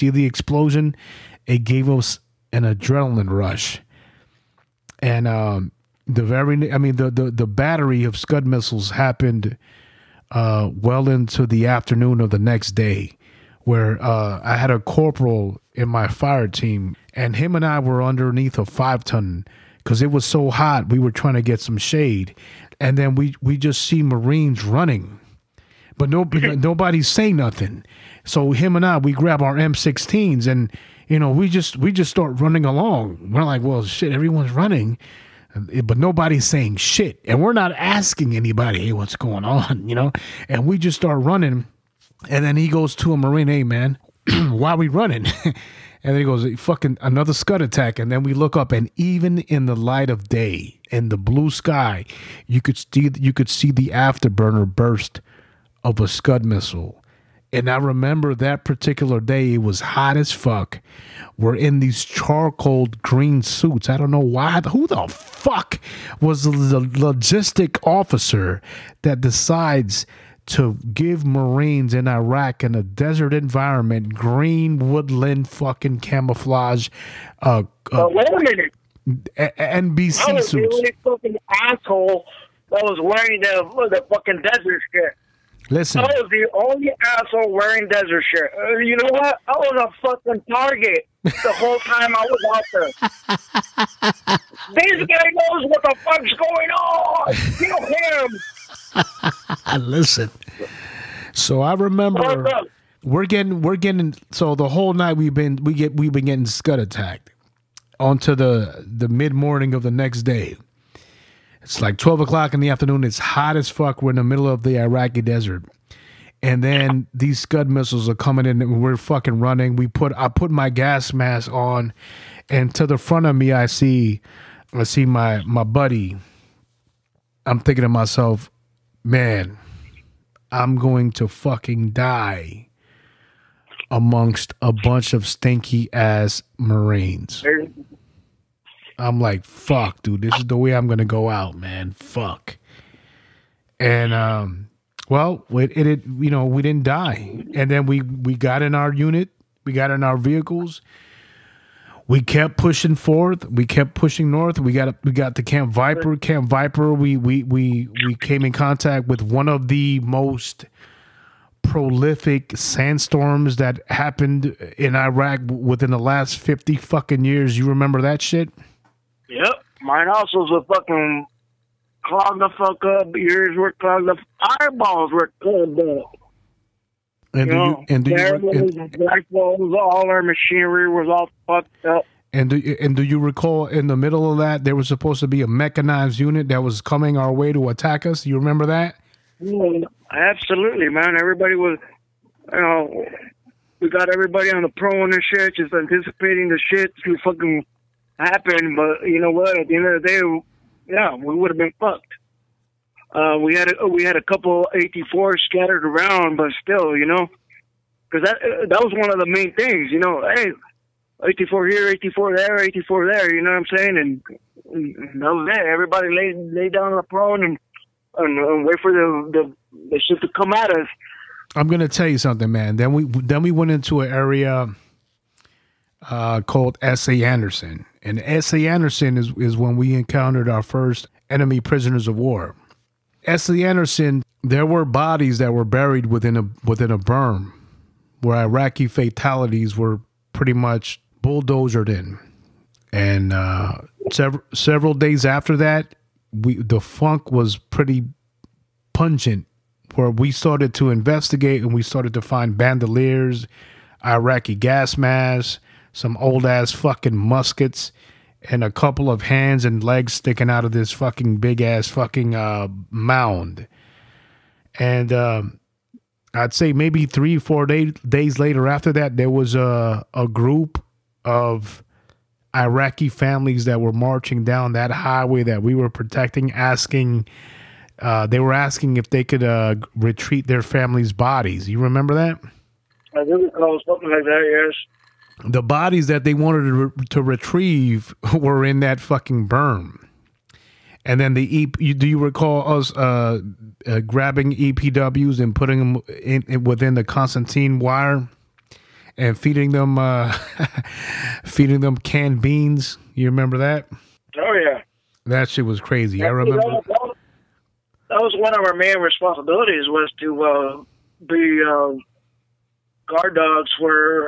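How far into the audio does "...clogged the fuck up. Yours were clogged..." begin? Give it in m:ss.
2:52.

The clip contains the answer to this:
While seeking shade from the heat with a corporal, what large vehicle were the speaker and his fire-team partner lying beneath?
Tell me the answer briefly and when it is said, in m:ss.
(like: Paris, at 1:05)
five ton, at 0:18.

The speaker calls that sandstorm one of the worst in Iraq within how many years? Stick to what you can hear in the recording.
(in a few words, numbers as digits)
50.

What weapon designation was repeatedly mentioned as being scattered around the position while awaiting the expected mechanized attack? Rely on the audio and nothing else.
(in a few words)
84.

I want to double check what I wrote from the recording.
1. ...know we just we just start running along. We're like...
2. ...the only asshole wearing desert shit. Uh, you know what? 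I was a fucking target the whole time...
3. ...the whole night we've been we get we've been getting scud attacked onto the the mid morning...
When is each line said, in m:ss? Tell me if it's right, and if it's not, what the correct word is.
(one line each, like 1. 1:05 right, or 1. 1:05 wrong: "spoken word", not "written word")
1. 0:31 right
2. 1:26 right
3. 1:44 right.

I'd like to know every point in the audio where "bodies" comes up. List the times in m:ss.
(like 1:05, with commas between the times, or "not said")
3:54, 4:41, 4:45.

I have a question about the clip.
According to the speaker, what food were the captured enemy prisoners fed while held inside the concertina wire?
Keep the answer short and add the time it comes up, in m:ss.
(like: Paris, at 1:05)
canned beans, at 5:01.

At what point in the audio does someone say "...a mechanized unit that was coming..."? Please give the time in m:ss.
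3:05.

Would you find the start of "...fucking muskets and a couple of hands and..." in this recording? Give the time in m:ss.
4:16.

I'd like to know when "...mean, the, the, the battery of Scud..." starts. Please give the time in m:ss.
0:06.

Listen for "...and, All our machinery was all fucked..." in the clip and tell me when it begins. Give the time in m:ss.
2:58.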